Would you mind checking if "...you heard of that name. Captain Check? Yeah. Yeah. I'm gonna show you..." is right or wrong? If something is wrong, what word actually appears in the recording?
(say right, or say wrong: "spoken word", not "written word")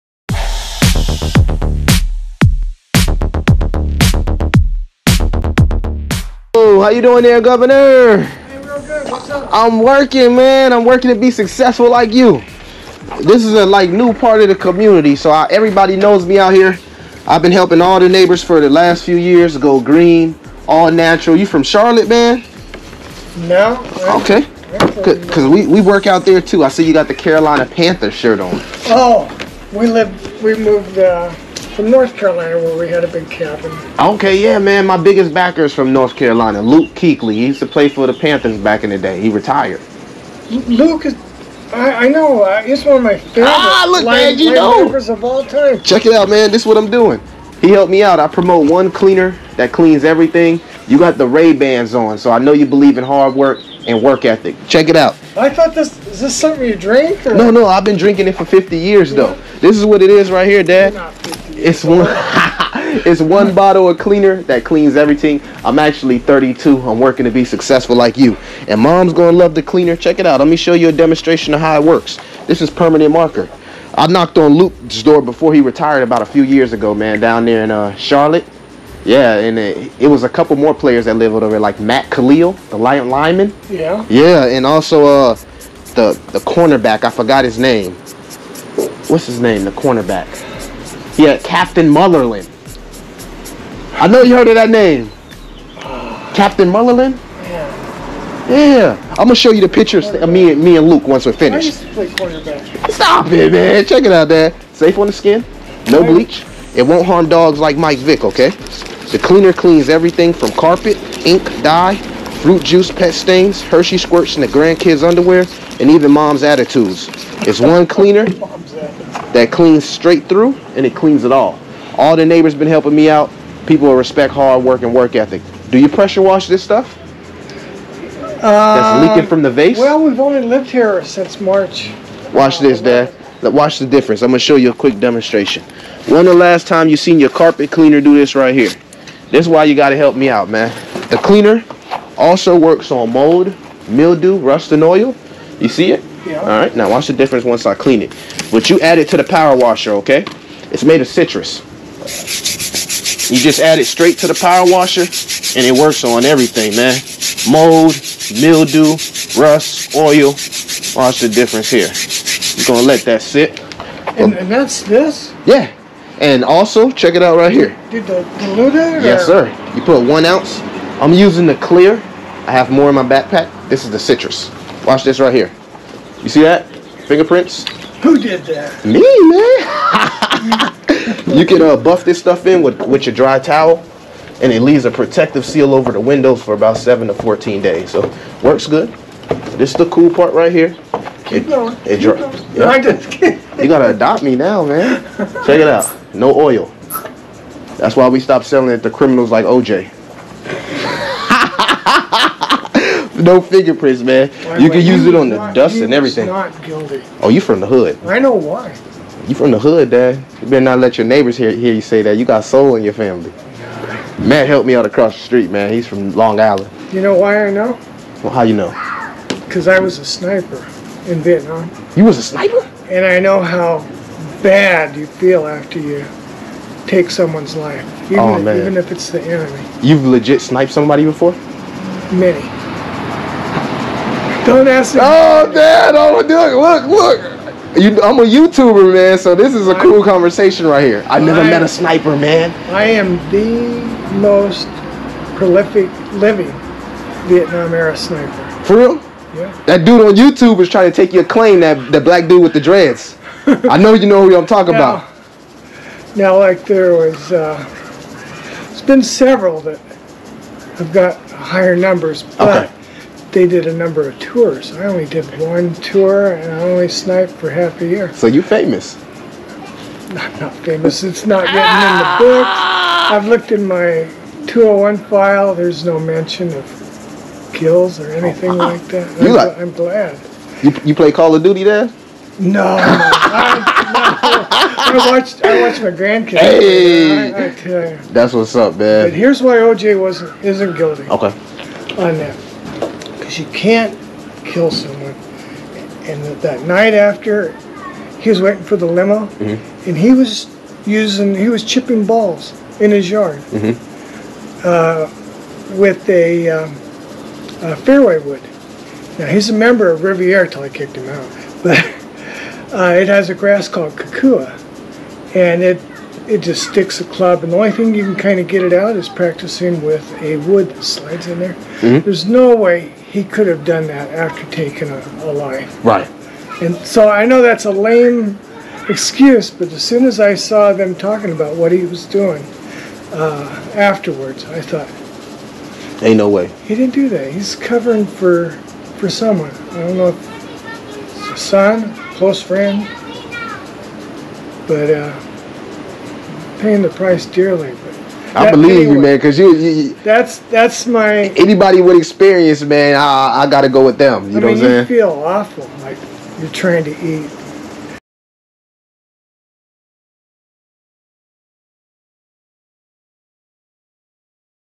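wrong: "Munnerlyn", not "Check".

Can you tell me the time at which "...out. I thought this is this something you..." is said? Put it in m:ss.
0:54.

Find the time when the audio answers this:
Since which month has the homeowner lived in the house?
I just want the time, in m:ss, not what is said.
2:11.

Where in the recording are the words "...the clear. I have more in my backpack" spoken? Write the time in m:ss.
2:51.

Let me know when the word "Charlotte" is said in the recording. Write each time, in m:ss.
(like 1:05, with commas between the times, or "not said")
0:21, 1:17.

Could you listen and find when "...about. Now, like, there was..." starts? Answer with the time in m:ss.
4:14.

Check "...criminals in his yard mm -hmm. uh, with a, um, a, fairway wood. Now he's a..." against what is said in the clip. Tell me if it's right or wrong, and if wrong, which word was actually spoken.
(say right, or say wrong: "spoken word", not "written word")
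wrong: "balls", not "criminals".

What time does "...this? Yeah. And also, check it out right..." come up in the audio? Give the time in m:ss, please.
2:44.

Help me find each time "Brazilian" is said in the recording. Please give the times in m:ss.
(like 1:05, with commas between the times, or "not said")
not said.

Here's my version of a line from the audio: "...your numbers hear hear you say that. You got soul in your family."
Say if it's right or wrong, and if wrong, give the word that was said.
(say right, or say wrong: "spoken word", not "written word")
wrong: "neighbors", not "numbers".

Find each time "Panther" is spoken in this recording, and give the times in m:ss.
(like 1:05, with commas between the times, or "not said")
0:27, 0:38.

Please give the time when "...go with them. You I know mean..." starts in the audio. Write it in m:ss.
5:53.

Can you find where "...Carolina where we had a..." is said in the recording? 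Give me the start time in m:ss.
0:32.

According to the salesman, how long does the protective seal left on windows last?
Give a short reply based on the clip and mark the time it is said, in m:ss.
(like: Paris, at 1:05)
7 to 14 days, at 3:06.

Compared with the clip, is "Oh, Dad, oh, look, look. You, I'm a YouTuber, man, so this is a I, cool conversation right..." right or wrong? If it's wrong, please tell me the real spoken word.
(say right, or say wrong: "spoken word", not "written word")
right.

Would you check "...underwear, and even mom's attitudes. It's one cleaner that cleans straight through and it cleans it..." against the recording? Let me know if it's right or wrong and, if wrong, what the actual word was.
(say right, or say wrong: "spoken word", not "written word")
right.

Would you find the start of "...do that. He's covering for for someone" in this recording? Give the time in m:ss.
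5:36.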